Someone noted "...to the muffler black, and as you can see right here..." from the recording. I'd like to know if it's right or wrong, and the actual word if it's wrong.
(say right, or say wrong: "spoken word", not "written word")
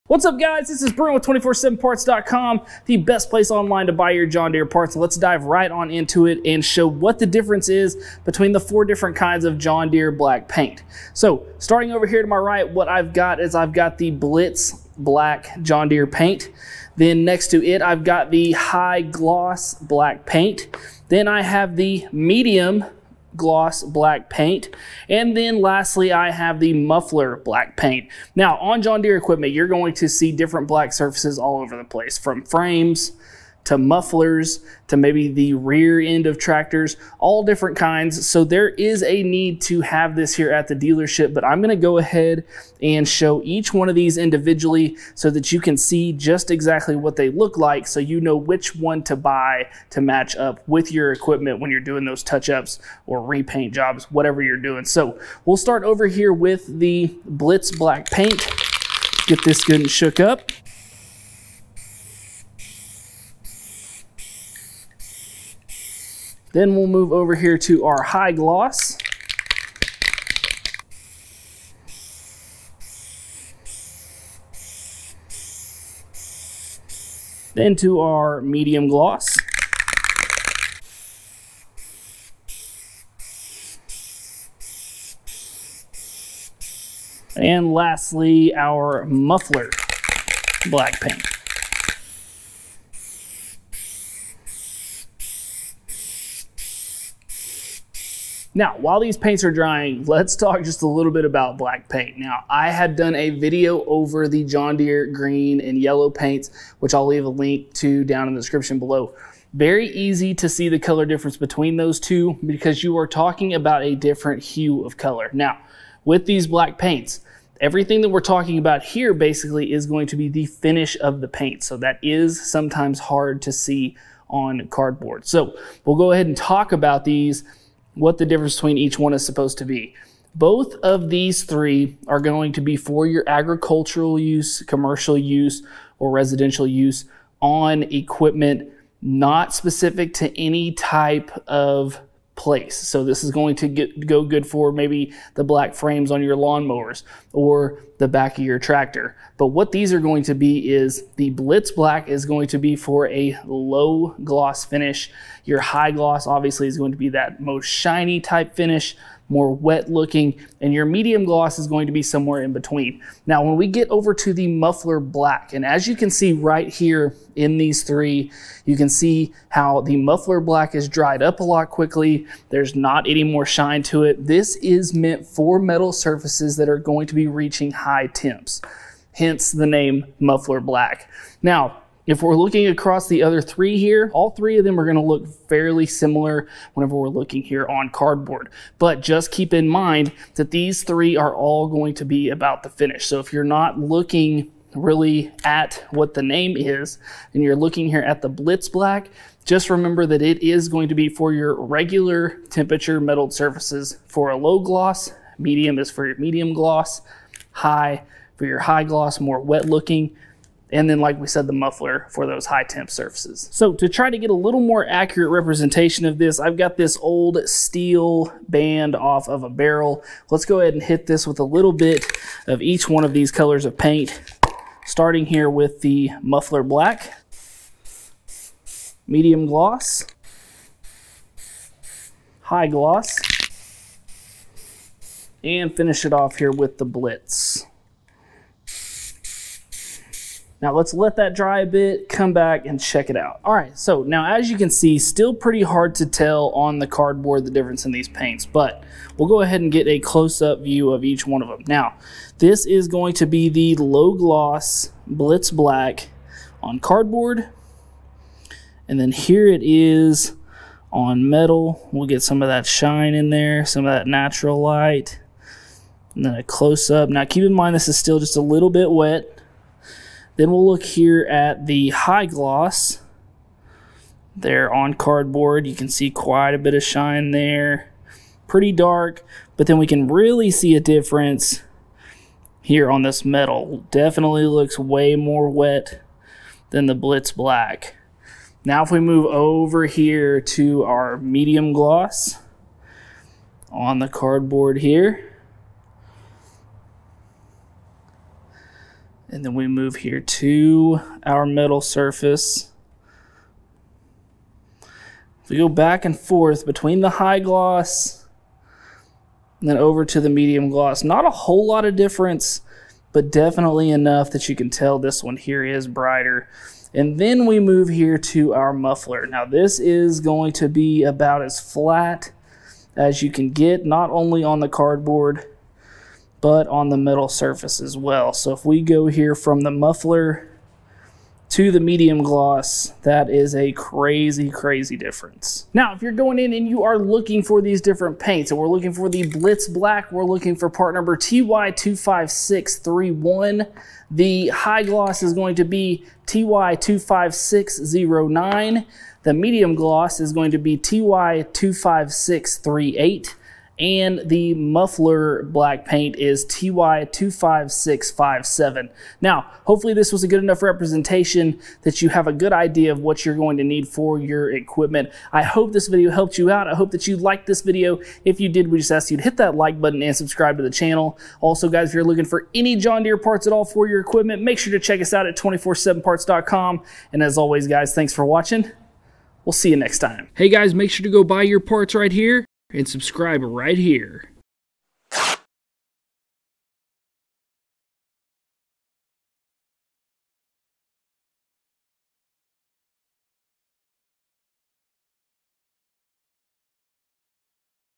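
right.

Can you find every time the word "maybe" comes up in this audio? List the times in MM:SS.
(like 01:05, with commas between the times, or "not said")
00:34, 02:24.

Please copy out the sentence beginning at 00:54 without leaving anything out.
So we'll start over here with the Blitz Black Paint.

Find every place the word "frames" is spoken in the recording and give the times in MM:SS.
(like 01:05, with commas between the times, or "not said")
00:32, 02:25.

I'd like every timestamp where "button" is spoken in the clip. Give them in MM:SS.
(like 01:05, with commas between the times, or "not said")
06:09.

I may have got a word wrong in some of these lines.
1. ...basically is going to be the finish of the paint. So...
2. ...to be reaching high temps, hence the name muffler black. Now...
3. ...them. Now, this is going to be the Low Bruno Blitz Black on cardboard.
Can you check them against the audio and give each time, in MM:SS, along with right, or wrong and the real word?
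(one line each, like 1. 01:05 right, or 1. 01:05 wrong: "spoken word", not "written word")
1. 01:59 right
2. 02:57 right
3. 04:11 wrong: "Gloss", not "Bruno".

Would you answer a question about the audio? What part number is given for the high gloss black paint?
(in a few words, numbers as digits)
TY25609.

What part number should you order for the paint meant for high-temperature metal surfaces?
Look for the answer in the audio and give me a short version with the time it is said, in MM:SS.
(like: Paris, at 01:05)
TY25657, at 05:56.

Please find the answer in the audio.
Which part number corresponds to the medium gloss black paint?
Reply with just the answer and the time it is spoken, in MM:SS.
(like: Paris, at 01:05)
TY25638, at 05:50.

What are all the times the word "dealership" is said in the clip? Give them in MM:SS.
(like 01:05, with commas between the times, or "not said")
00:40.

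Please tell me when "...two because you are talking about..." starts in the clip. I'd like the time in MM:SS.
01:51.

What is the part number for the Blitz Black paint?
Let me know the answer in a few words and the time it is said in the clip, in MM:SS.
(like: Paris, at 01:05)
TY25631, at 05:41.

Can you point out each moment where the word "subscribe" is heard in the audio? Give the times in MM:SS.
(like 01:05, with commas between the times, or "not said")
06:10, 06:22.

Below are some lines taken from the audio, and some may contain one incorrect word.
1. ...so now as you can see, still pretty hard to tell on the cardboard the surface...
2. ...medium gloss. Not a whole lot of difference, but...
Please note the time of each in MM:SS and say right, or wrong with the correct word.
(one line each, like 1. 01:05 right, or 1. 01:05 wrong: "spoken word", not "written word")
1. 04:03 wrong: "difference", not "surface"
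2. 05:10 right.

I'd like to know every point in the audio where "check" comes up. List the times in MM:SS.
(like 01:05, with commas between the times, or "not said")
04:02, 06:14.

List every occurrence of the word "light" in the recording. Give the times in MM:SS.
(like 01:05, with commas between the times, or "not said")
04:24.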